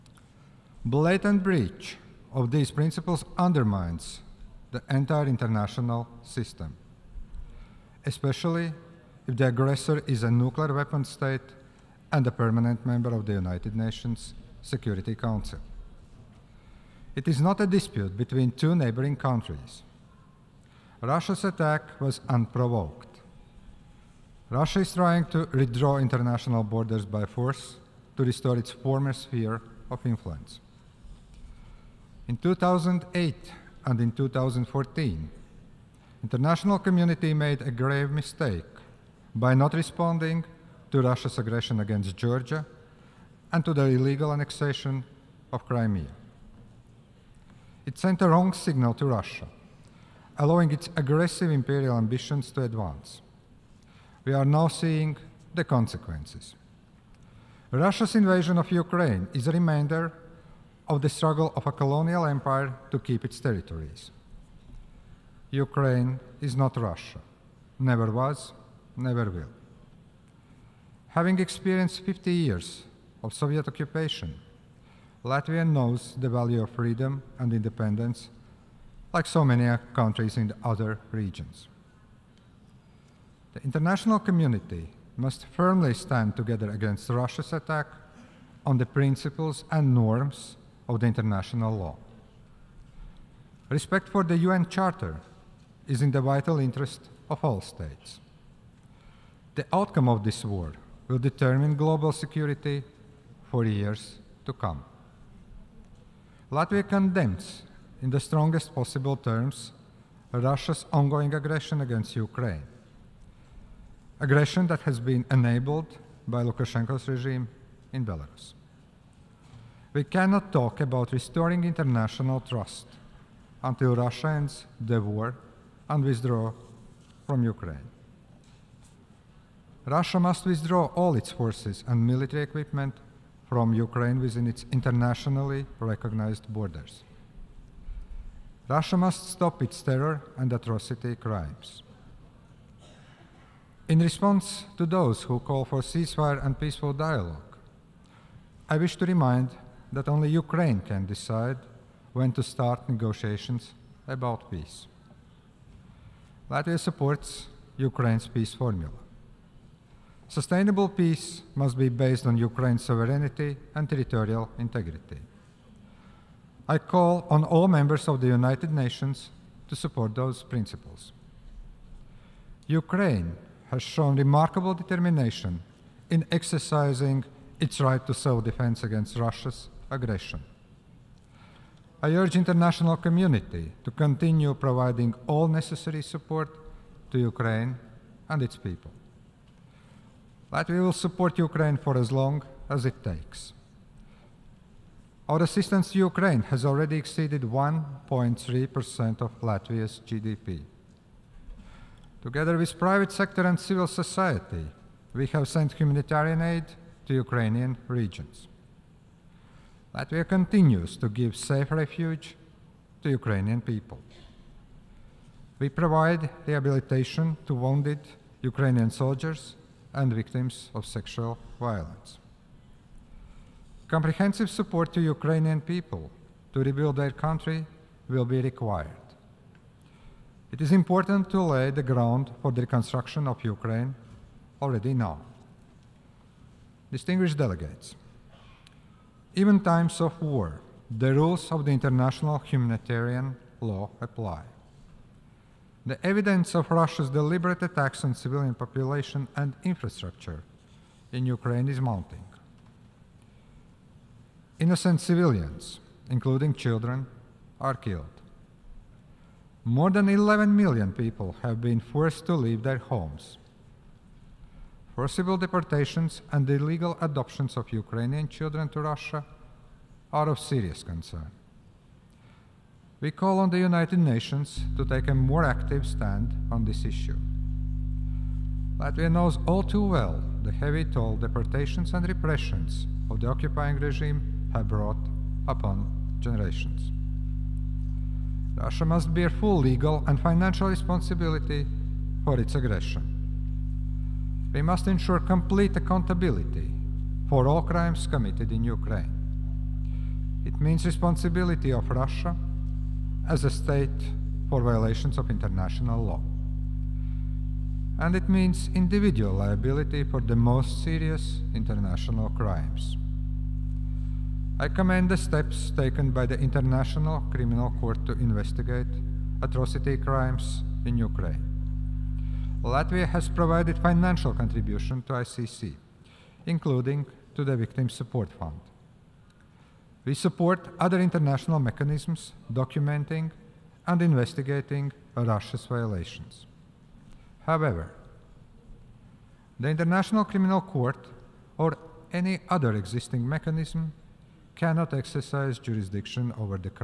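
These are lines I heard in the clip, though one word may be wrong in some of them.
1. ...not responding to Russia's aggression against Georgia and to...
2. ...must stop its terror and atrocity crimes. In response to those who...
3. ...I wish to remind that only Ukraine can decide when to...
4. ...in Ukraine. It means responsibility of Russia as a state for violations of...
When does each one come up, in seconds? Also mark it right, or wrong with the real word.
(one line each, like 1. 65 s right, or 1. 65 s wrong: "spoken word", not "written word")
1. 39 s right
2. 138 s right
3. 148 s right
4. 298 s right.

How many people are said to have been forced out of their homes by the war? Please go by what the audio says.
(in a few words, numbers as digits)
More than 11 million.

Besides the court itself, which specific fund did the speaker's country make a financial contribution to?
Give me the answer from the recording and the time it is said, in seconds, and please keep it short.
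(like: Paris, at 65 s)
Victim Support Fund, at 327 s.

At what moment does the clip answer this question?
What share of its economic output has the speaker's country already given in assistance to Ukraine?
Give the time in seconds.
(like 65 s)
197 s.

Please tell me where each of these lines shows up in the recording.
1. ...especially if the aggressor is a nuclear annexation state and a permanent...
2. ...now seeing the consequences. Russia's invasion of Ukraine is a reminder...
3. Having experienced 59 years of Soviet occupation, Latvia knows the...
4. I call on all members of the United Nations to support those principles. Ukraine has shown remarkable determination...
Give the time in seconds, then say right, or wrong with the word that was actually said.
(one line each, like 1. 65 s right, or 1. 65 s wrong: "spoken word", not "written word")
1. 8 s wrong: "weapon", not "annexation"
2. 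54 s right
3. 71 s wrong: "50", not "59"
4. 166 s right.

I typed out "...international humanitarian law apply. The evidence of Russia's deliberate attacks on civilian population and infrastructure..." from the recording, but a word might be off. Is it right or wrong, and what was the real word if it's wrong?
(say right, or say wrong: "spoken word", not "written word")
right.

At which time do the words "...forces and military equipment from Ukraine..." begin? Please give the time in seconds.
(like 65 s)
131 s.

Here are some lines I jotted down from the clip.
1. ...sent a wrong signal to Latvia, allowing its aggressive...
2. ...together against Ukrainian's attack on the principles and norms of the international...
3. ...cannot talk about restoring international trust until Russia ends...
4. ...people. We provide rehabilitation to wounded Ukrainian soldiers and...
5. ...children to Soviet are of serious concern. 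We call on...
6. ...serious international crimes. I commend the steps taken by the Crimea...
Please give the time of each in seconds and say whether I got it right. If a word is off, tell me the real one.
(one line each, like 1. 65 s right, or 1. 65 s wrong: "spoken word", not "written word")
1. 47 s wrong: "Russia", not "Latvia"
2. 86 s wrong: "Russia", not "Ukrainian"
3. 120 s right
4. 213 s right
5. 268 s wrong: "Russia", not "Soviet"
6. 310 s wrong: "International", not "Crimea".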